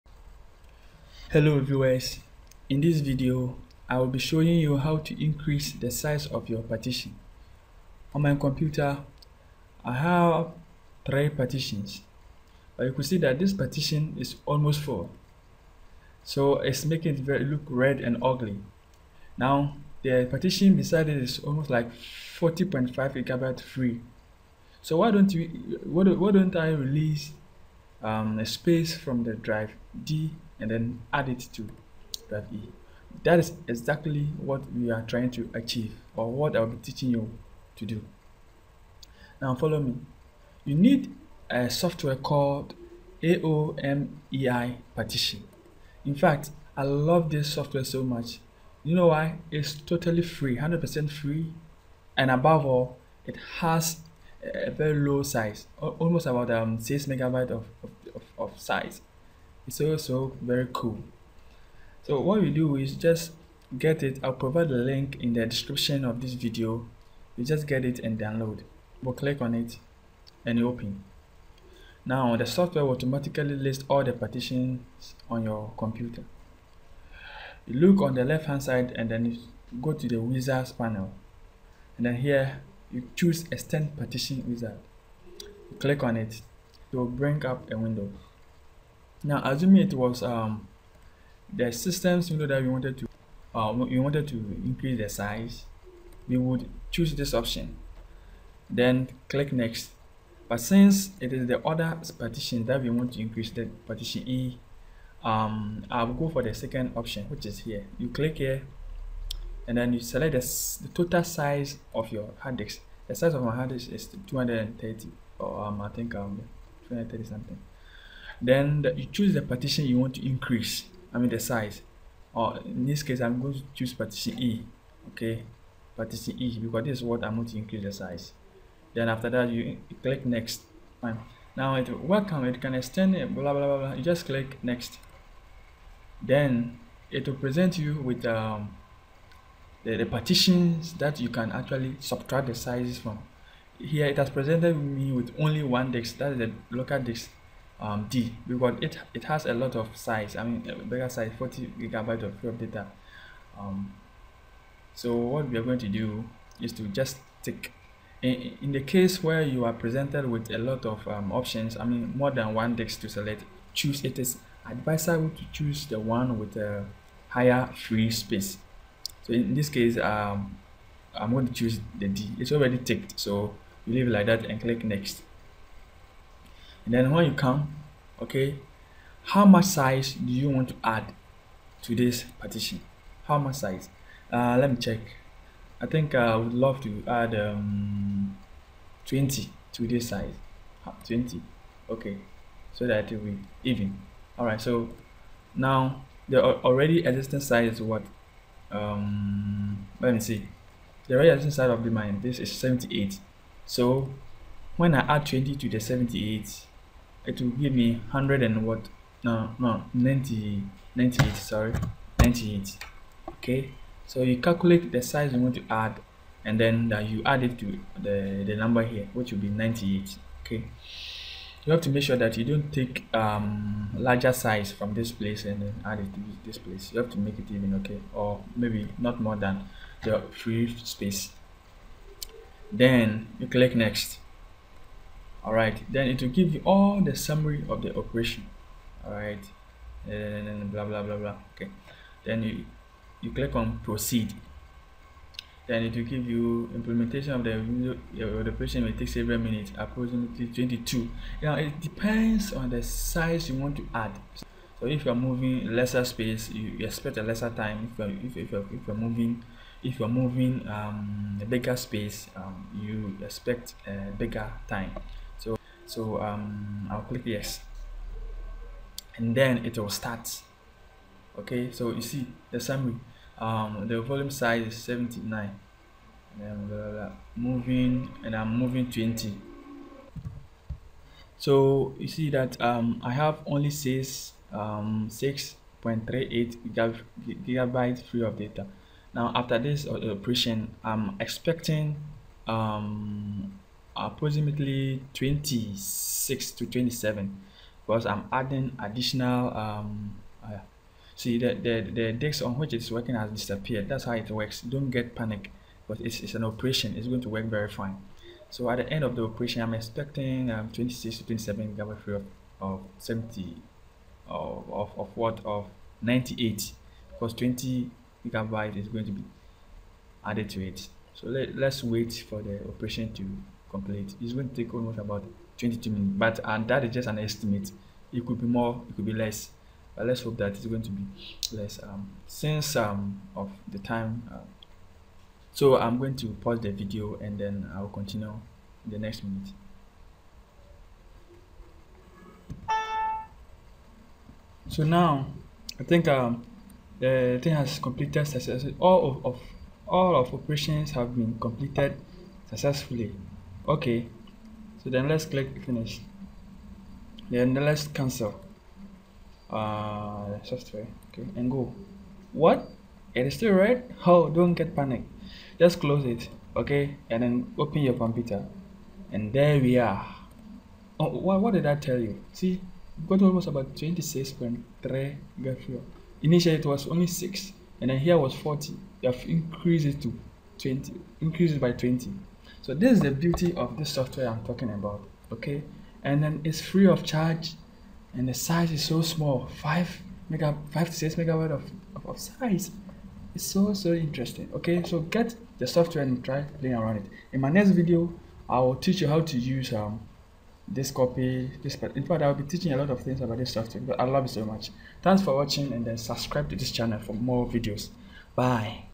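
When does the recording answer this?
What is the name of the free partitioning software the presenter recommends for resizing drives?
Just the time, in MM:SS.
00:43.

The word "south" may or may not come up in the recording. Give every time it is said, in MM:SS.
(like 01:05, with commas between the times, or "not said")
not said.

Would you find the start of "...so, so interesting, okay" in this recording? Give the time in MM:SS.
06:33.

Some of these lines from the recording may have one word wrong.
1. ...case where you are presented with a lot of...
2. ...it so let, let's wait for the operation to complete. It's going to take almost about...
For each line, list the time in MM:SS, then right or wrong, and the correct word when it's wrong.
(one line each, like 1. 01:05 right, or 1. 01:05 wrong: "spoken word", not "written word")
1. 02:38 right
2. 05:20 right.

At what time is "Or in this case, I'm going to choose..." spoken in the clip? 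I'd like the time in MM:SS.
02:02.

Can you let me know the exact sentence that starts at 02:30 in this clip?
I mean, bigger size, 40 gigabyte of free data.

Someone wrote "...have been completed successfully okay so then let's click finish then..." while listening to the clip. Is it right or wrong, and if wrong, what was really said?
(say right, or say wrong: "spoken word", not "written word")
right.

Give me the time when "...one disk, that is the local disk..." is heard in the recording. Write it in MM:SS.
02:25.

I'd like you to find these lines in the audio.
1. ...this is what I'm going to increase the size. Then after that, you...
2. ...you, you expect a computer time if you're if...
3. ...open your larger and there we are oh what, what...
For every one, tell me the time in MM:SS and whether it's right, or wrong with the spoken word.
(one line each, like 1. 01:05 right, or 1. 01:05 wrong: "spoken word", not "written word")
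1. 02:06 right
2. 04:16 wrong: "lesser", not "computer"
3. 06:07 wrong: "computer", not "larger".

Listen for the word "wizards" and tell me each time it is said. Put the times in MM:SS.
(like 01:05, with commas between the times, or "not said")
01:20, 01:24.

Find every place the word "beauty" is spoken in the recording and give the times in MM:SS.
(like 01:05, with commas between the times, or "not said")
06:23.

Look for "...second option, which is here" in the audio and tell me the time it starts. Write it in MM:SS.
01:46.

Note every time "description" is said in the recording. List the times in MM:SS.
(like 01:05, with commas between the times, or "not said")
01:05.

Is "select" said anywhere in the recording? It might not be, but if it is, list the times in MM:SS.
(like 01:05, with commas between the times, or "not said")
01:49, 02:43.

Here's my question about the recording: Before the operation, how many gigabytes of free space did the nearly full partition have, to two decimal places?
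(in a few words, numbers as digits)
6.38.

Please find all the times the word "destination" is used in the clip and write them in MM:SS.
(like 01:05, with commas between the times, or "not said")
not said.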